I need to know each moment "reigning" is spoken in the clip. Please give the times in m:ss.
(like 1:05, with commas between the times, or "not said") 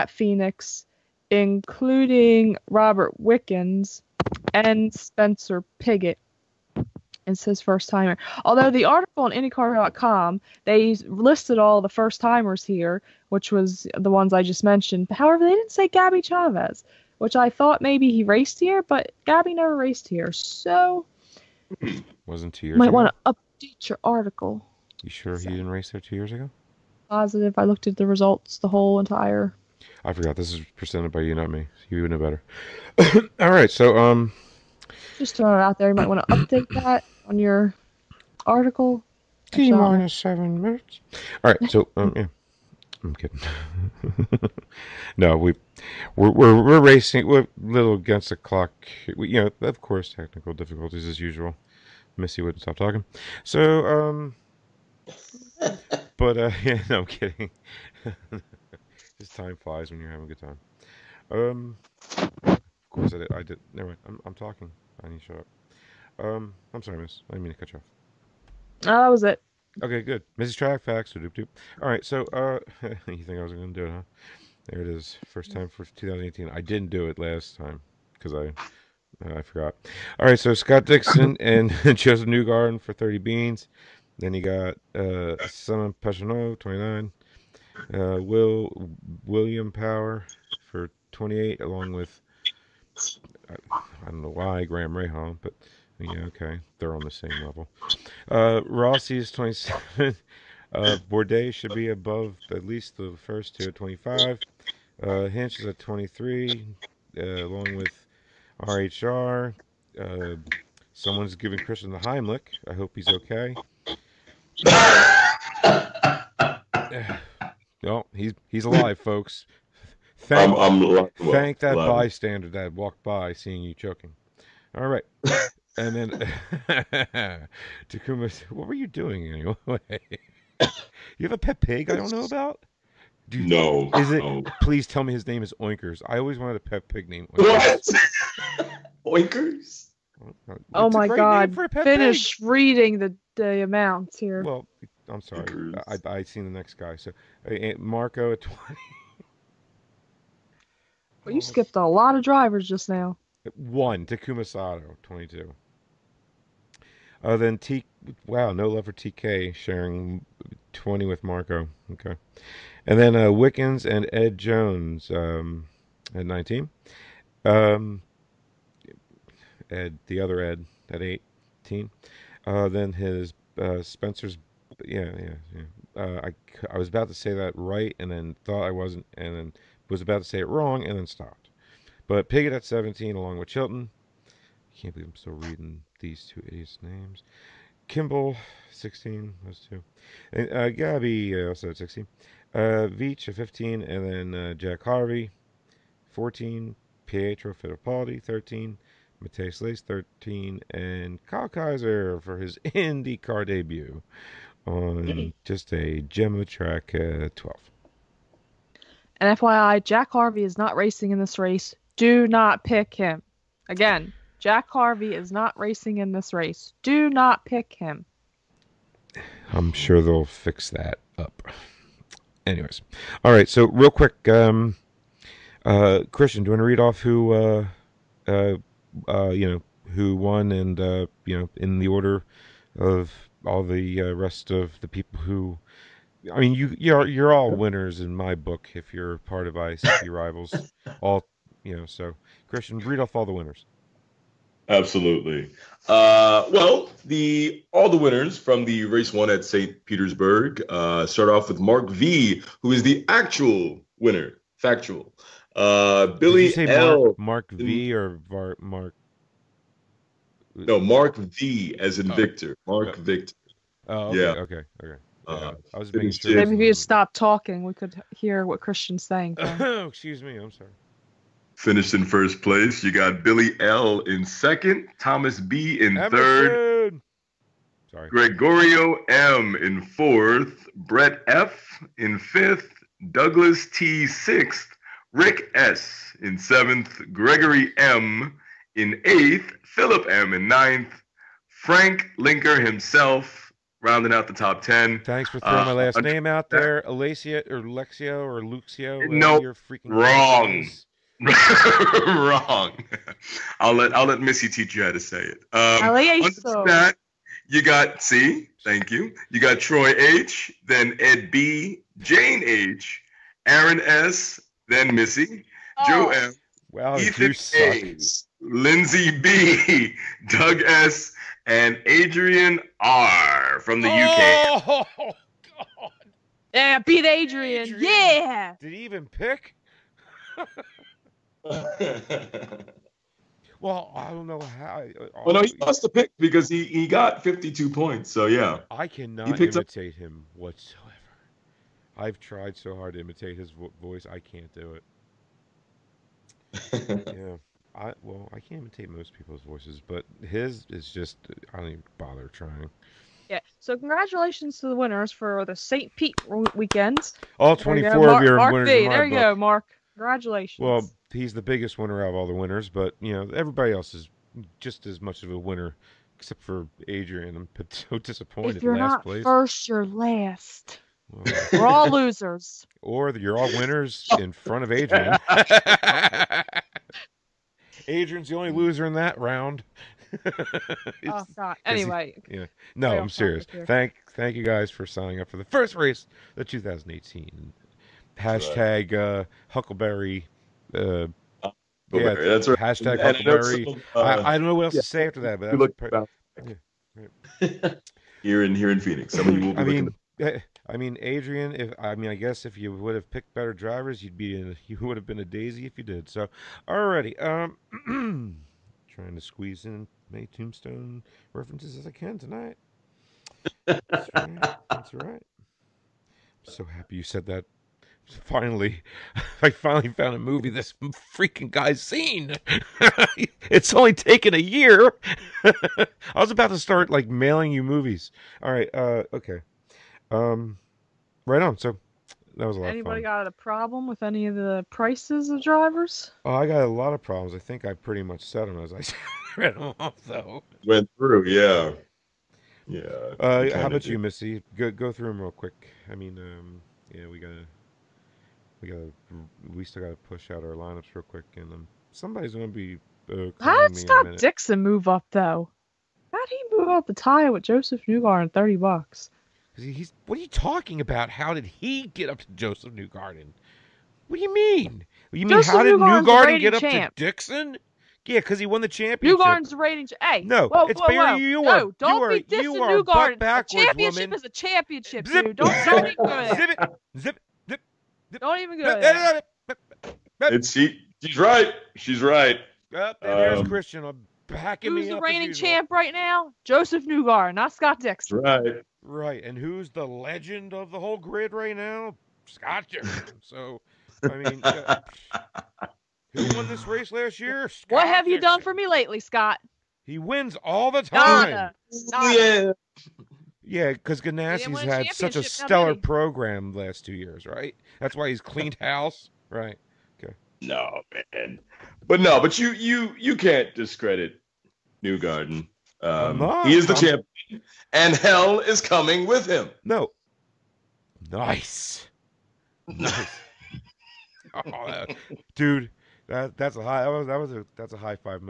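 7:49, 8:05.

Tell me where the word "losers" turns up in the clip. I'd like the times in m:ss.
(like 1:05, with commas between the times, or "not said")
6:11, 6:18.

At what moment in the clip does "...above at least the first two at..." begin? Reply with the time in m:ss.
1:41.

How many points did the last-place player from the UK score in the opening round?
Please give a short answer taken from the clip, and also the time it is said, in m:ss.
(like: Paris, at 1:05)
52, at 5:37.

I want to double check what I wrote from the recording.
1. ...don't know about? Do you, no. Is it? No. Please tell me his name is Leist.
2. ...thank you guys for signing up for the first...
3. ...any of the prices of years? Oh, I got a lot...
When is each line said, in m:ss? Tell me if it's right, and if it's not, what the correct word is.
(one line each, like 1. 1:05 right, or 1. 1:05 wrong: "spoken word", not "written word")
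1. 2:11 wrong: "Oinkers", not "Leist"
2. 6:24 right
3. 7:14 wrong: "drivers", not "years".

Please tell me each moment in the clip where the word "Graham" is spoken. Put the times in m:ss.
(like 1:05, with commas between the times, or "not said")
1:34.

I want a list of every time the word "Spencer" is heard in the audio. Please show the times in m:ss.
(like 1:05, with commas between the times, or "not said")
0:04, 2:53.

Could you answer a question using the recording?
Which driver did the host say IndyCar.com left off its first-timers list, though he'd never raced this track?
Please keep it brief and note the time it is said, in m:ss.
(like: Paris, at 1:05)
Gabby Chaves, at 0:15.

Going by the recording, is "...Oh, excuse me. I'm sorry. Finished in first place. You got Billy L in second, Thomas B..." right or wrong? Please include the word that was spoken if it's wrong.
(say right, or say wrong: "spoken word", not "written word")
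right.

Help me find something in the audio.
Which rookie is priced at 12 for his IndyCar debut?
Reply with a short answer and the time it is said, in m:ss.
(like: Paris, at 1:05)
Kyle Kaiser, at 3:21.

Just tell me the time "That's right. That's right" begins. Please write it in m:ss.
6:53.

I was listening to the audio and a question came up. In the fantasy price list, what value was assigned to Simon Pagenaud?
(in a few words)
29.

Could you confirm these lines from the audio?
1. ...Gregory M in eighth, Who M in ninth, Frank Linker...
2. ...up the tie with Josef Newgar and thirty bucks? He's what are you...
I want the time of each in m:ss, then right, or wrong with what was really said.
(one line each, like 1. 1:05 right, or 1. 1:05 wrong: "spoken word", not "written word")
1. 4:47 wrong: "Philip", not "Who"
2. 7:36 right.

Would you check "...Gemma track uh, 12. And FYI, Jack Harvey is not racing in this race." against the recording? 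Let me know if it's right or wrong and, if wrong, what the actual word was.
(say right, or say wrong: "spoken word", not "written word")
right.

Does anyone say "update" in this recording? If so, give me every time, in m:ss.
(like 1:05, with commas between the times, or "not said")
0:23, 0:36.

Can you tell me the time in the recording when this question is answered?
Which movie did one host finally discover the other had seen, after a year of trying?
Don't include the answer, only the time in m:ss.
6:50.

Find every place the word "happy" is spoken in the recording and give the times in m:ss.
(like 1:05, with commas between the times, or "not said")
6:56.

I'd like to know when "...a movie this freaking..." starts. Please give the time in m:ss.
7:00.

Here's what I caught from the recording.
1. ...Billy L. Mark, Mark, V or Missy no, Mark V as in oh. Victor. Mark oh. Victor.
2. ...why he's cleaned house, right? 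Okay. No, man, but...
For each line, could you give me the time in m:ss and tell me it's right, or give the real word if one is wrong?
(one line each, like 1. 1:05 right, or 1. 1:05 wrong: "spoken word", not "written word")
1. 4:16 wrong: "Mark", not "Missy"
2. 8:27 right.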